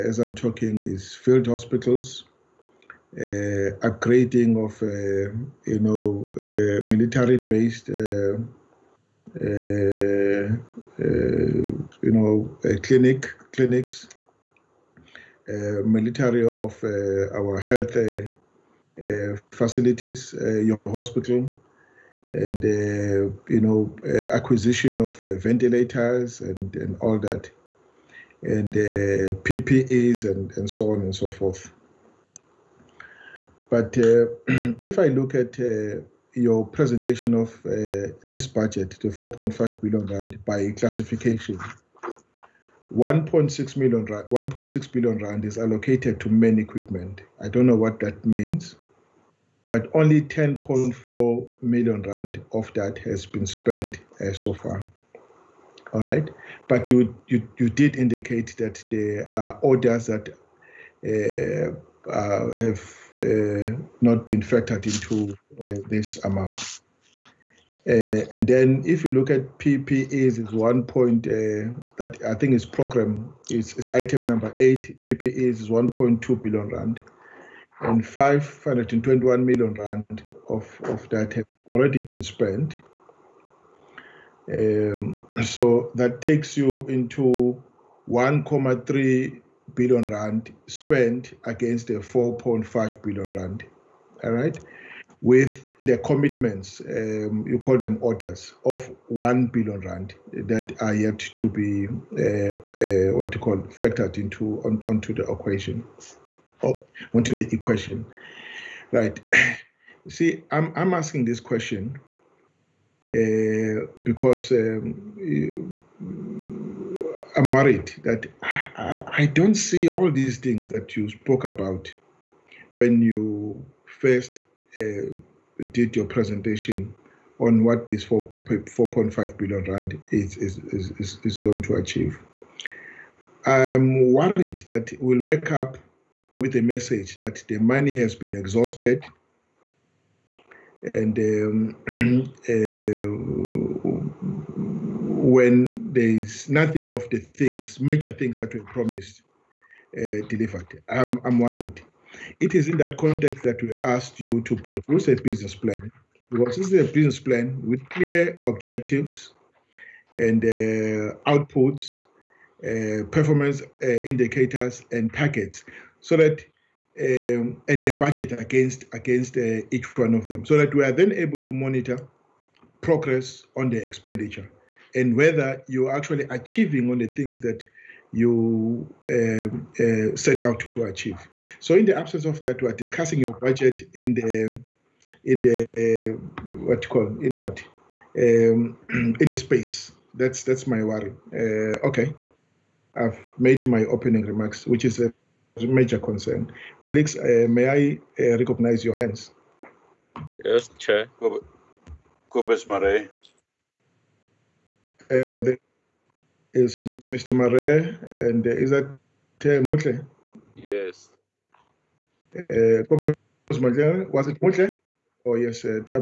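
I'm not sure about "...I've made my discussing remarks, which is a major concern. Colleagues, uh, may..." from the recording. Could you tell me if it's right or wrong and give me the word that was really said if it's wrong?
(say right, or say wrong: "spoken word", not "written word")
wrong: "opening", not "discussing".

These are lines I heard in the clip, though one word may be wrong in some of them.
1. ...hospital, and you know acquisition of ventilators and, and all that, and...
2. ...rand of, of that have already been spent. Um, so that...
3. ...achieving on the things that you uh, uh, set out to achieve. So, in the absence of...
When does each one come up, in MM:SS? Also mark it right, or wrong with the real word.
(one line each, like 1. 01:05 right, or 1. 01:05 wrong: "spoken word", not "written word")
1. 00:20 right
2. 01:19 right
3. 02:56 right.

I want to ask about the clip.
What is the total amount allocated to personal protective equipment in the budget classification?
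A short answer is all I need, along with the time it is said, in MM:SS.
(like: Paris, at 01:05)
R1.2 billion, at 01:15.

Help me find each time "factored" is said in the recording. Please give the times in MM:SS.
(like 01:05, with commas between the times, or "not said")
01:04, 01:43.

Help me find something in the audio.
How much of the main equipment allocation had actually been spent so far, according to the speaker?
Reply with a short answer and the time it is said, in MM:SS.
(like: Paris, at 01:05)
R10.4 million, at 00:50.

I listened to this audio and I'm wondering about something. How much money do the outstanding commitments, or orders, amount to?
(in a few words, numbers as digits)
R1 billion.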